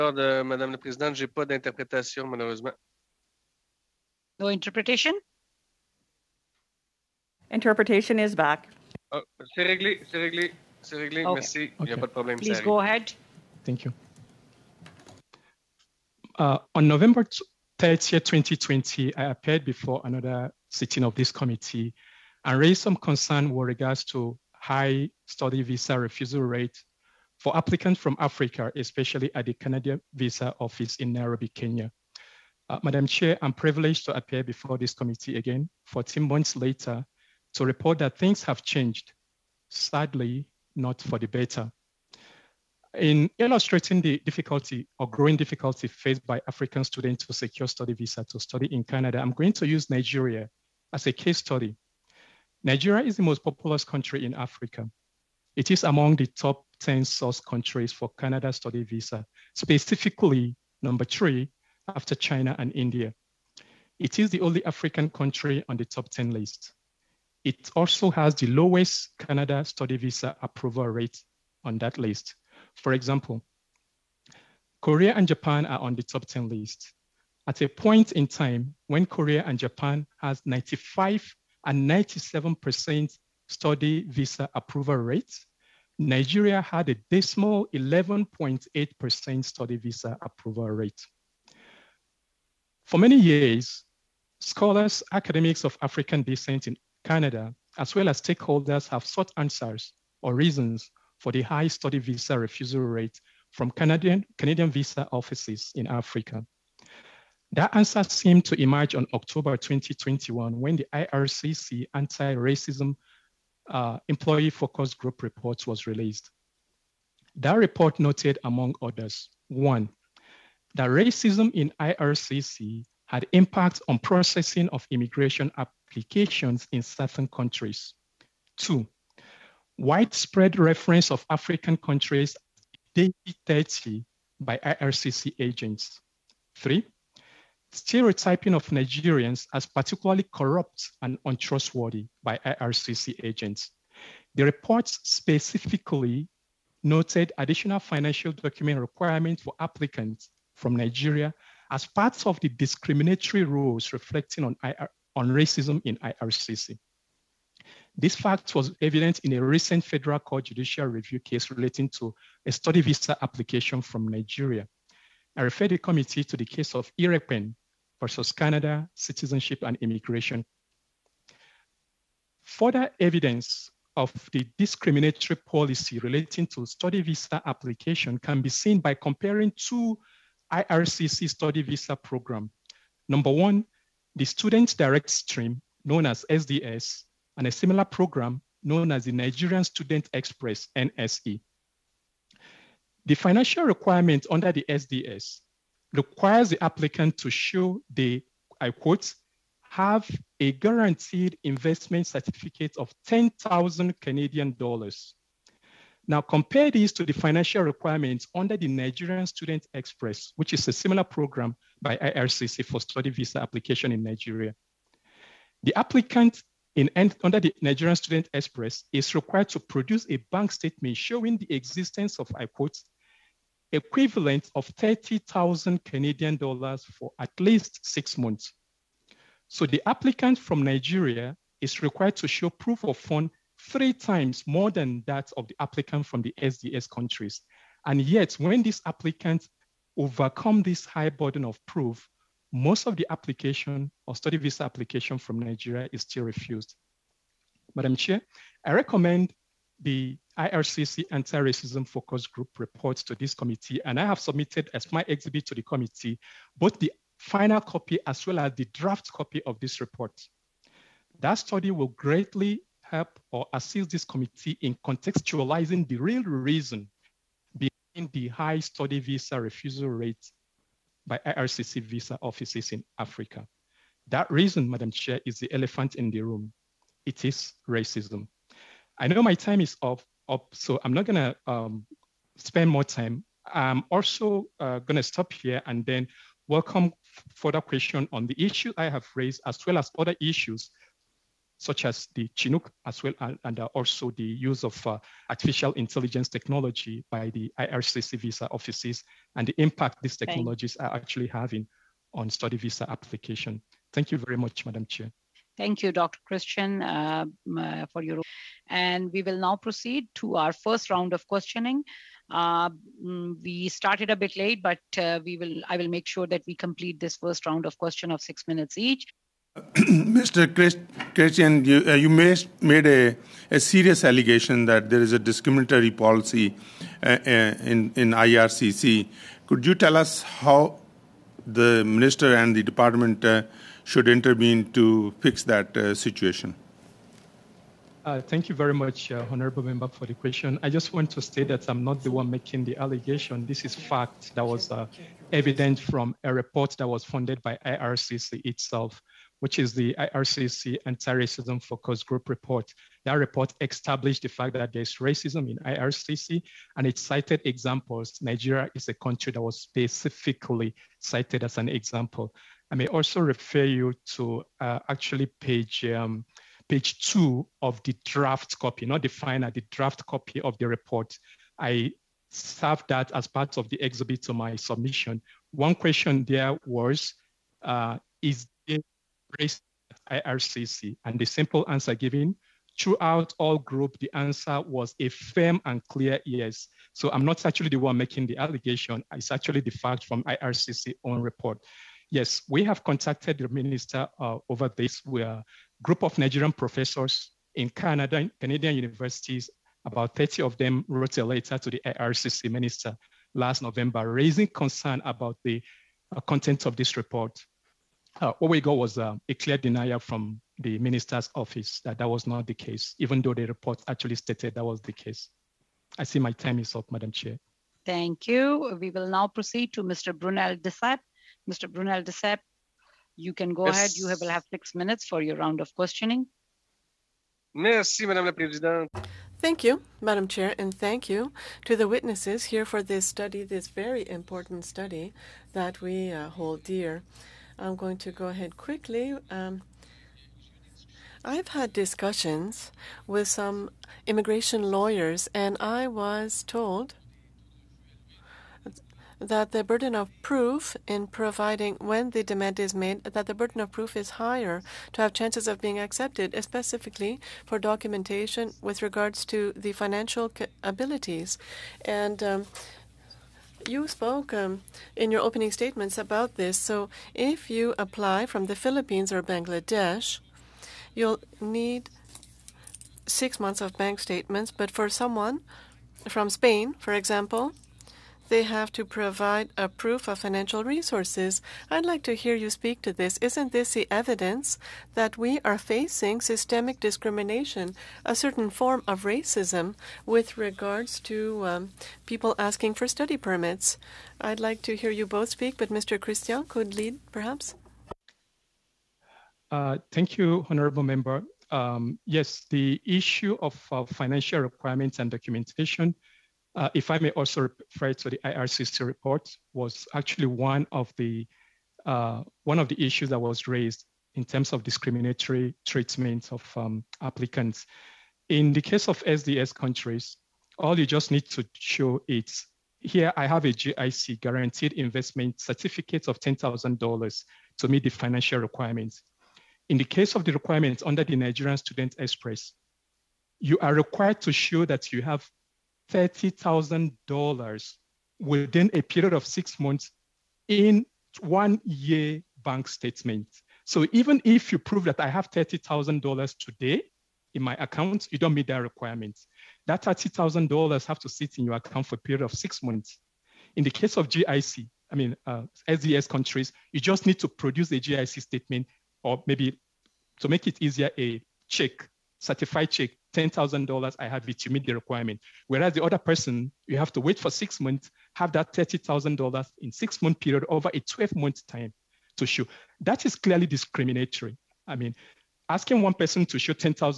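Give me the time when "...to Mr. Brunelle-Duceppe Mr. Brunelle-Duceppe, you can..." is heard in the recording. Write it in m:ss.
6:59.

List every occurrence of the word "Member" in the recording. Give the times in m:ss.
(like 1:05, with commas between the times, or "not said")
5:39, 8:20.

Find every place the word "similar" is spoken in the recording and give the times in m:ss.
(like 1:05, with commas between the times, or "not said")
3:07, 3:30.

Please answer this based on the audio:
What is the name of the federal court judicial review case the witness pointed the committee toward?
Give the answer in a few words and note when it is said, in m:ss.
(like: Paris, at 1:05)
IREPEN versus Canada, at 2:46.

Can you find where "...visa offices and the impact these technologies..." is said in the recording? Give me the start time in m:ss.
4:58.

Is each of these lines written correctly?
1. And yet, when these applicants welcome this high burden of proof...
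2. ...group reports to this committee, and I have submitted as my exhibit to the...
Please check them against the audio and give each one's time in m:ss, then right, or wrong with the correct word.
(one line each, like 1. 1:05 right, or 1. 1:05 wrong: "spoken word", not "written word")
1. 3:57 wrong: "overcome", not "welcome"
2. 4:12 right.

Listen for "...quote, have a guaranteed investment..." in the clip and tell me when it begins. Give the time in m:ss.
3:18.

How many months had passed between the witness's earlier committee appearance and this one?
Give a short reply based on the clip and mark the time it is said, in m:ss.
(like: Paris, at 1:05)
14 months, at 0:35.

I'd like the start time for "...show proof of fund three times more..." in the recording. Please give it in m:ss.
3:52.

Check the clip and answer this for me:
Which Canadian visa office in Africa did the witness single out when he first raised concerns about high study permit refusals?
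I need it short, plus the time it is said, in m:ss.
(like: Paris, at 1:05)
Nairobi, at 0:31.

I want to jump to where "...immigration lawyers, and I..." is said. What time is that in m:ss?
7:24.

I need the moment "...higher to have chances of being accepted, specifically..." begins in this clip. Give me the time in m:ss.
7:34.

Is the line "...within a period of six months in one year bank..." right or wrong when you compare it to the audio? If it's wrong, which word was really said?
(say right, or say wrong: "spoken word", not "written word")
right.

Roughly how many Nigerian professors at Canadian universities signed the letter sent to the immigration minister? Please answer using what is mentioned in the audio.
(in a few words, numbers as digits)
30.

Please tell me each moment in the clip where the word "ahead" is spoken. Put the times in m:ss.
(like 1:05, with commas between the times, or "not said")
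0:12, 7:03, 7:18.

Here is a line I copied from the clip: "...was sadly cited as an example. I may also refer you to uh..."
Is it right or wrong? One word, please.
wrong.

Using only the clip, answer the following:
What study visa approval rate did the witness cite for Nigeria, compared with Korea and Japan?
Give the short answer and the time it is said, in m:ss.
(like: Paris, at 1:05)
11.8%, at 1:27.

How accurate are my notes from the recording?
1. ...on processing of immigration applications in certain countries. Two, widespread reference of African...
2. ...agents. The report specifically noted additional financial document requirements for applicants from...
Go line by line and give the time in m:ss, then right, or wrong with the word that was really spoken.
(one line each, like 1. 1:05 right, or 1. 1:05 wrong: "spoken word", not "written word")
1. 2:03 right
2. 2:23 right.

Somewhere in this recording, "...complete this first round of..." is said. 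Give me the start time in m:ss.
5:16.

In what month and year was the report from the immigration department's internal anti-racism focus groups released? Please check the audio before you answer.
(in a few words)
October 2021.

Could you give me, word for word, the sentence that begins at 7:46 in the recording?
So if you apply from the Philippines or Bangladesh, you'll need six months of bank statements.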